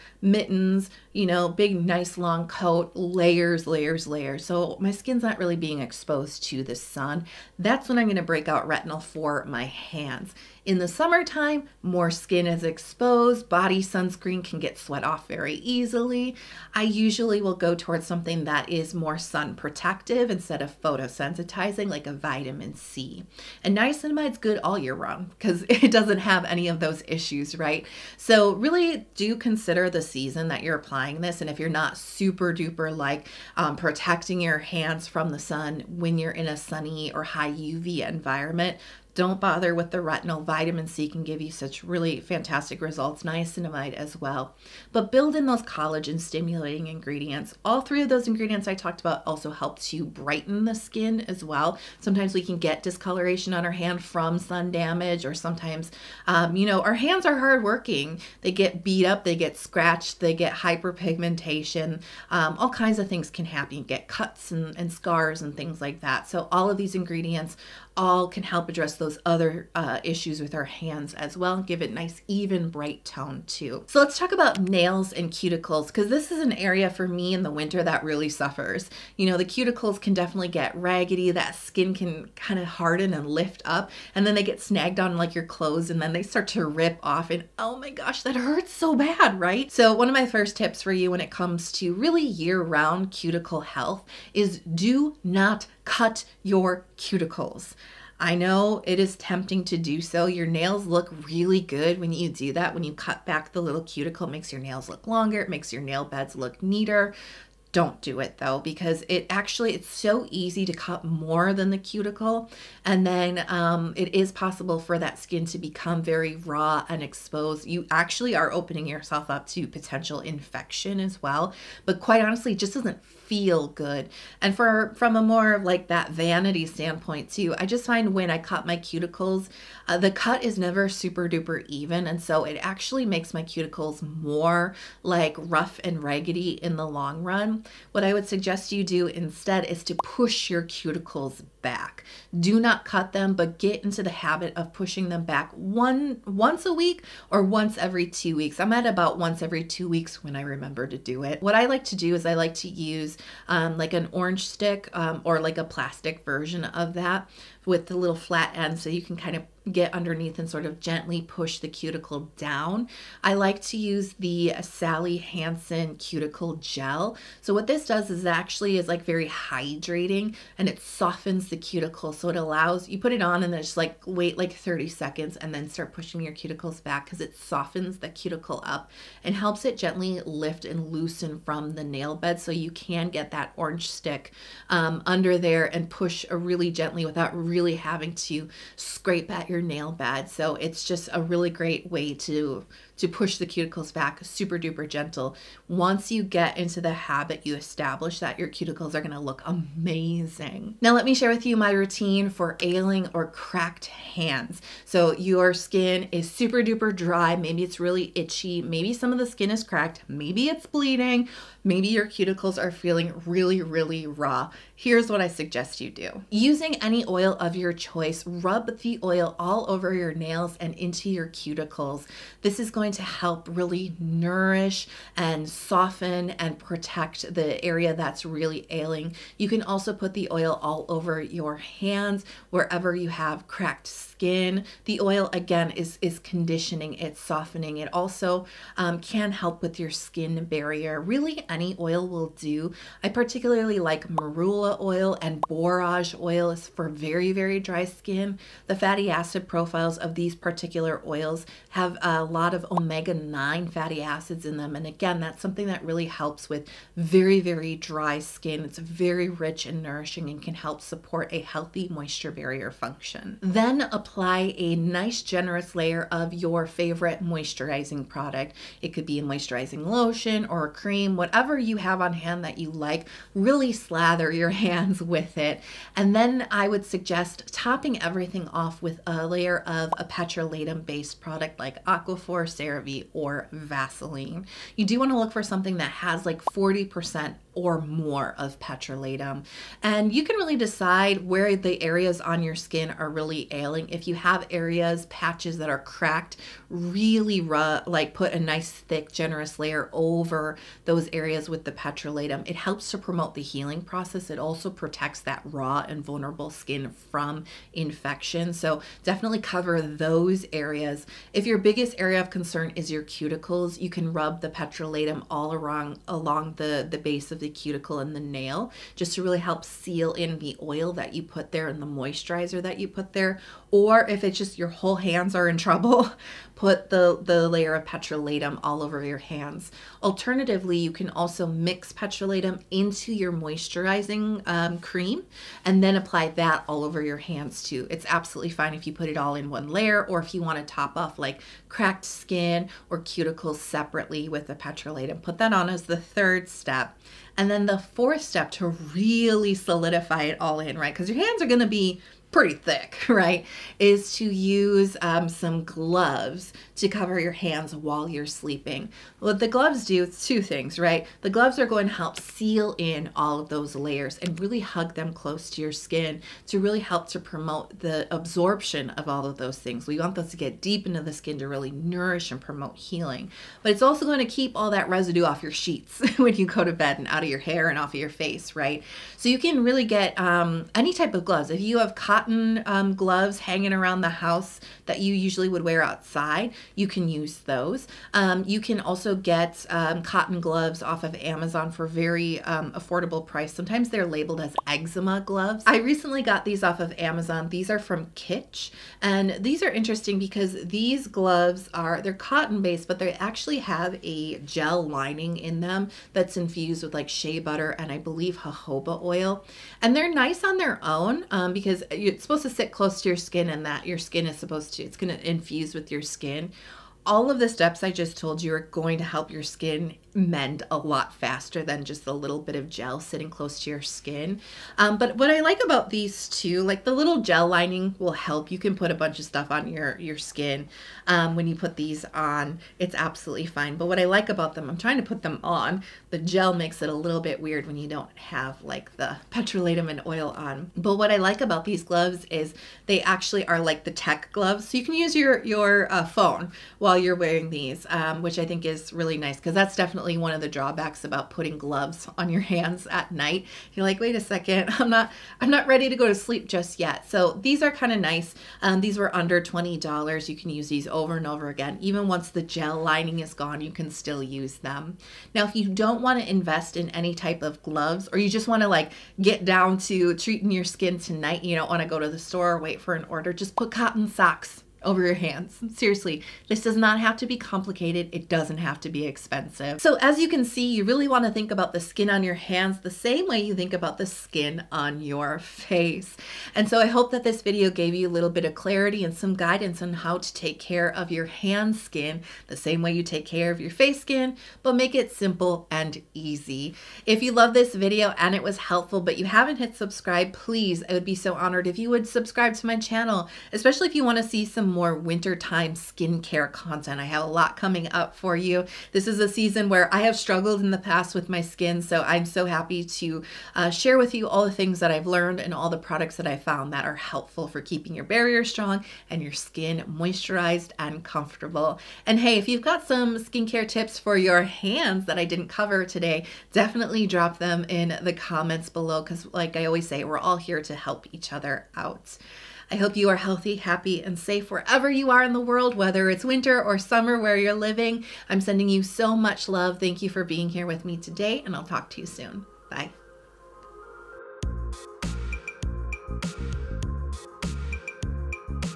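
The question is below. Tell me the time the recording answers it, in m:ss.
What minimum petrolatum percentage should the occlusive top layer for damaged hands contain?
4:46.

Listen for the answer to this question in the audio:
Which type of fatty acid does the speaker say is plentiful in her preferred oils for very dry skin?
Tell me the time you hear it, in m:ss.
4:12.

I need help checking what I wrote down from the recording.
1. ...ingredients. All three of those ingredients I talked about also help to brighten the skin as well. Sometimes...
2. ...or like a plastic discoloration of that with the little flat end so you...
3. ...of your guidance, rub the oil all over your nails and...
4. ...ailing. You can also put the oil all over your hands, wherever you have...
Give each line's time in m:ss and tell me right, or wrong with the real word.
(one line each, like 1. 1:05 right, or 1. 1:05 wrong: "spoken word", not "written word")
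1. 0:46 right
2. 2:35 wrong: "version", not "discoloration"
3. 3:37 wrong: "choice", not "guidance"
4. 3:48 right.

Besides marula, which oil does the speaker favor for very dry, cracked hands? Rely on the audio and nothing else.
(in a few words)
Borage oil.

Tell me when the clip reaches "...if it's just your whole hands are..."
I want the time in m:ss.
5:24.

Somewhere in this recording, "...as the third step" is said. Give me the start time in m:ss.
5:45.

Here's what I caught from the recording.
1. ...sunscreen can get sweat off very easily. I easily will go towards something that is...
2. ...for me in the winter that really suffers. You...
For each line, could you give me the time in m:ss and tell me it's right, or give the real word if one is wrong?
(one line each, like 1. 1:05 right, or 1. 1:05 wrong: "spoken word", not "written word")
1. 0:13 wrong: "usually", not "easily"
2. 1:16 right.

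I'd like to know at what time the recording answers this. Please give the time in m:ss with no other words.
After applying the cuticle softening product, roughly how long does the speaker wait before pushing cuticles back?
2:54.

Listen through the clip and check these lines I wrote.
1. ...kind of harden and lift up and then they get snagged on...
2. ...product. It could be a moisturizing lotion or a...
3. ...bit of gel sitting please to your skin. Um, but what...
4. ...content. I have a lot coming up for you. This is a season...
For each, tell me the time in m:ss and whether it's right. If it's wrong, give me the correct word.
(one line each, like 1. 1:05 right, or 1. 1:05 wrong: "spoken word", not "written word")
1. 1:22 right
2. 4:28 right
3. 7:02 wrong: "close", not "please"
4. 8:26 right.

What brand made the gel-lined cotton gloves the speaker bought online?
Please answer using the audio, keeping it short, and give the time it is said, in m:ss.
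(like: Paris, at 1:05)
Kitsch, at 6:38.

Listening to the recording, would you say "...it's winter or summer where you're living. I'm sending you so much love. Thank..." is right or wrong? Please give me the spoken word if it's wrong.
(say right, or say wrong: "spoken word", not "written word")
right.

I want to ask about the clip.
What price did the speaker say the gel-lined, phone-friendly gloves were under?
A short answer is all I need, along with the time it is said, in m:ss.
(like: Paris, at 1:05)
$20, at 7:39.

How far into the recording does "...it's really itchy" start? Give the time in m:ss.
3:27.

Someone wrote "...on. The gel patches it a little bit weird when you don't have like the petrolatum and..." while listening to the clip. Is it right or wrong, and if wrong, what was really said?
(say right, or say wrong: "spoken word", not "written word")
wrong: "makes", not "patches".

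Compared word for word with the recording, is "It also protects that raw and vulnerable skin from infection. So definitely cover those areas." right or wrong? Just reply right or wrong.
right.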